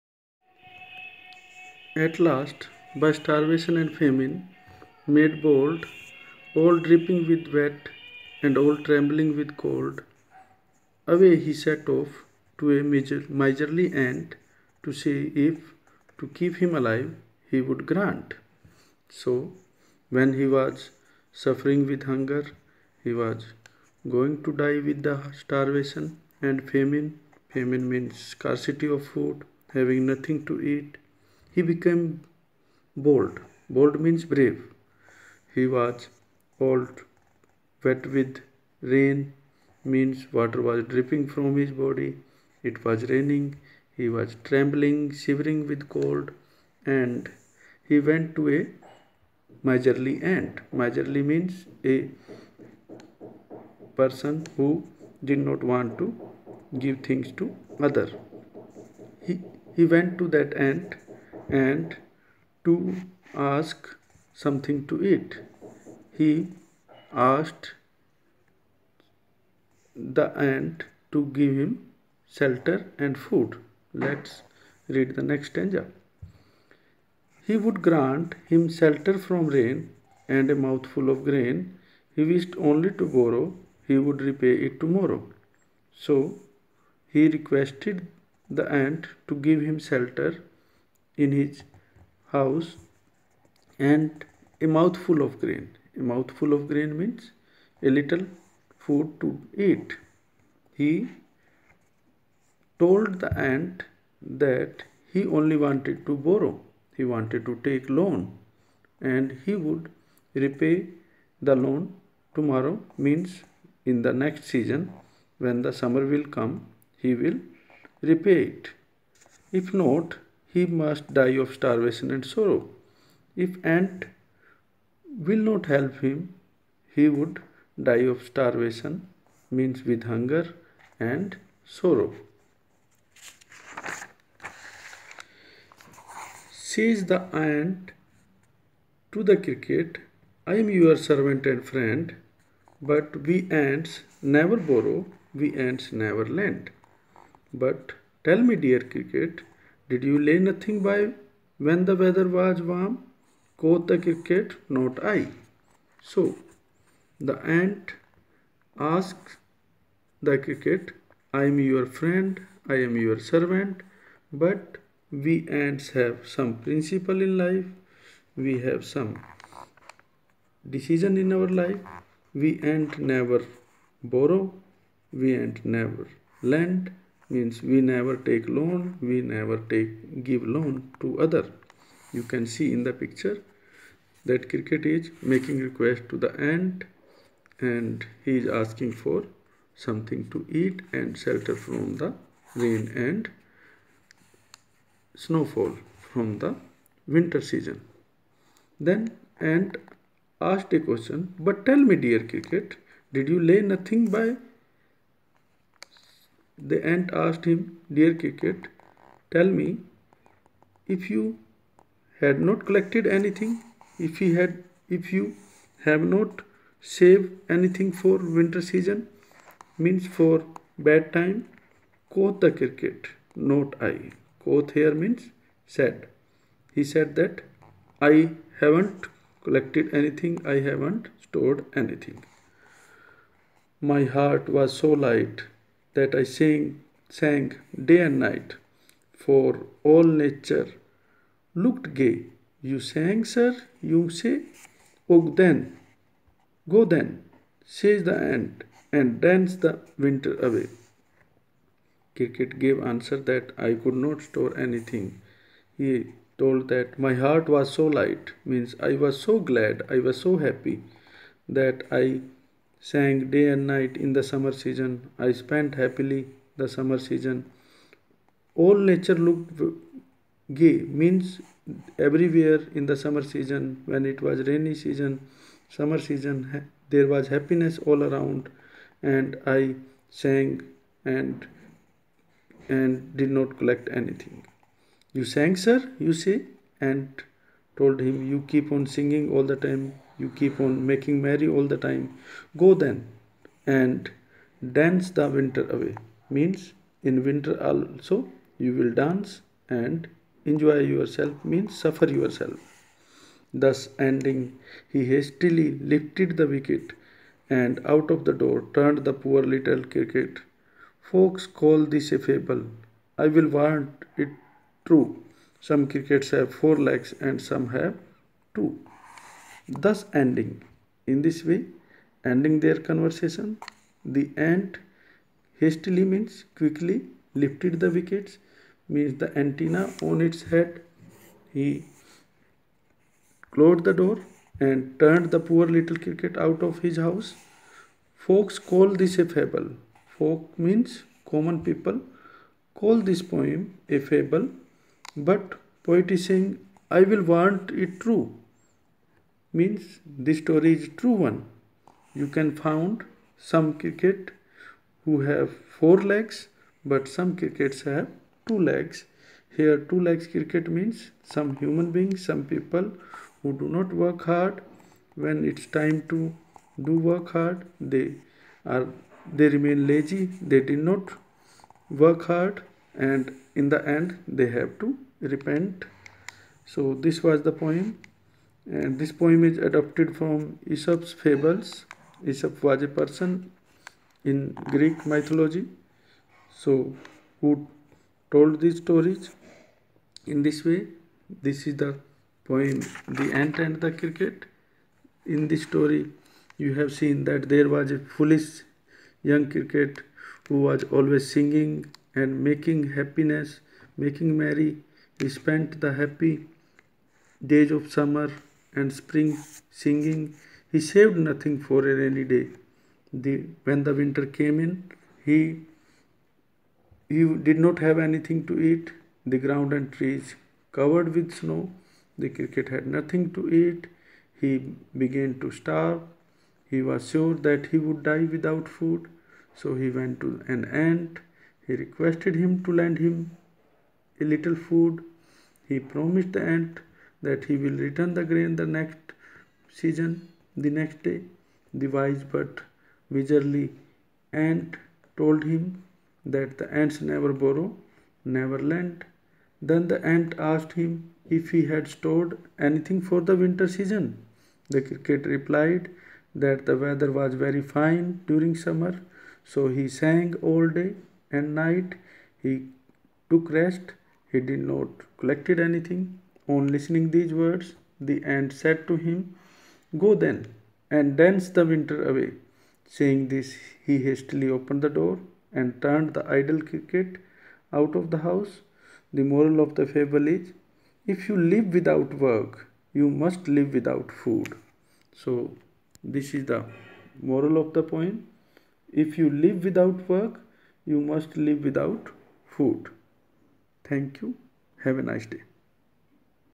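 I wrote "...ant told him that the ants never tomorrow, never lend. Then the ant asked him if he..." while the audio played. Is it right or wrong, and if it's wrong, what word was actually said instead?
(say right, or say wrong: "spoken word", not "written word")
wrong: "borrow", not "tomorrow".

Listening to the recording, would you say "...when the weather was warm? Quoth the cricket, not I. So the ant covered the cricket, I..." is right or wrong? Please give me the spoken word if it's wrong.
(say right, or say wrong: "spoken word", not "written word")
wrong: "asked", not "covered".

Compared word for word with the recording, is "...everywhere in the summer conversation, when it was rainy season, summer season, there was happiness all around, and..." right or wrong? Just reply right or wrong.
wrong.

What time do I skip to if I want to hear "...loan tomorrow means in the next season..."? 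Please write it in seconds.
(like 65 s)
111 s.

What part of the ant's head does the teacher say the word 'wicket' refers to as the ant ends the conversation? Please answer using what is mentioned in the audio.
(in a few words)
antenna.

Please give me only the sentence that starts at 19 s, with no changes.
So, when he was suffering with hunger, he was going to die with the starvation and famine.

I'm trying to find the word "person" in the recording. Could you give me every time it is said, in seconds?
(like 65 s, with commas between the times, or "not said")
54 s, 382 s.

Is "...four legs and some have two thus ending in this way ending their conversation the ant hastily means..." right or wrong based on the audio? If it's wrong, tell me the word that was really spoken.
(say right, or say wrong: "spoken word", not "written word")
right.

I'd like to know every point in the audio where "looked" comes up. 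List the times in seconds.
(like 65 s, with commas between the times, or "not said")
241 s, 269 s.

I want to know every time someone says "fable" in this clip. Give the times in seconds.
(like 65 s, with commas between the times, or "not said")
312 s, 339 s, 344 s, 381 s, 479 s.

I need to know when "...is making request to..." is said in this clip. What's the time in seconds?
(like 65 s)
184 s.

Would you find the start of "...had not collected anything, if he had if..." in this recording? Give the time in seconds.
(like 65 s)
212 s.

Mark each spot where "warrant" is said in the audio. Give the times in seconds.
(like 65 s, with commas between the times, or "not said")
313 s, 347 s.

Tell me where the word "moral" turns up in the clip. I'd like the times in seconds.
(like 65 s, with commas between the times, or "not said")
479 s, 487 s.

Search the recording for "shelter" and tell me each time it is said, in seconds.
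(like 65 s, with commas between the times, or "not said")
72 s, 78 s, 89 s, 191 s.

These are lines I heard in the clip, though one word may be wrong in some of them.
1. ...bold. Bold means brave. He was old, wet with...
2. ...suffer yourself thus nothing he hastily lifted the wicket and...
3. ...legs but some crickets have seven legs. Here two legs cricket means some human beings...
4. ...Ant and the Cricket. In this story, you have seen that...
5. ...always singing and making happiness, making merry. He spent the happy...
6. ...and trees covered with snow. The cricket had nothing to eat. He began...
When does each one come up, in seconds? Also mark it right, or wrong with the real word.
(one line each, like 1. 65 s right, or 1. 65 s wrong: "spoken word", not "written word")
1. 33 s right
2. 301 s wrong: "ending", not "nothing"
3. 356 s wrong: "two", not "seven"
4. 393 s right
5. 400 s right
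6. 419 s right.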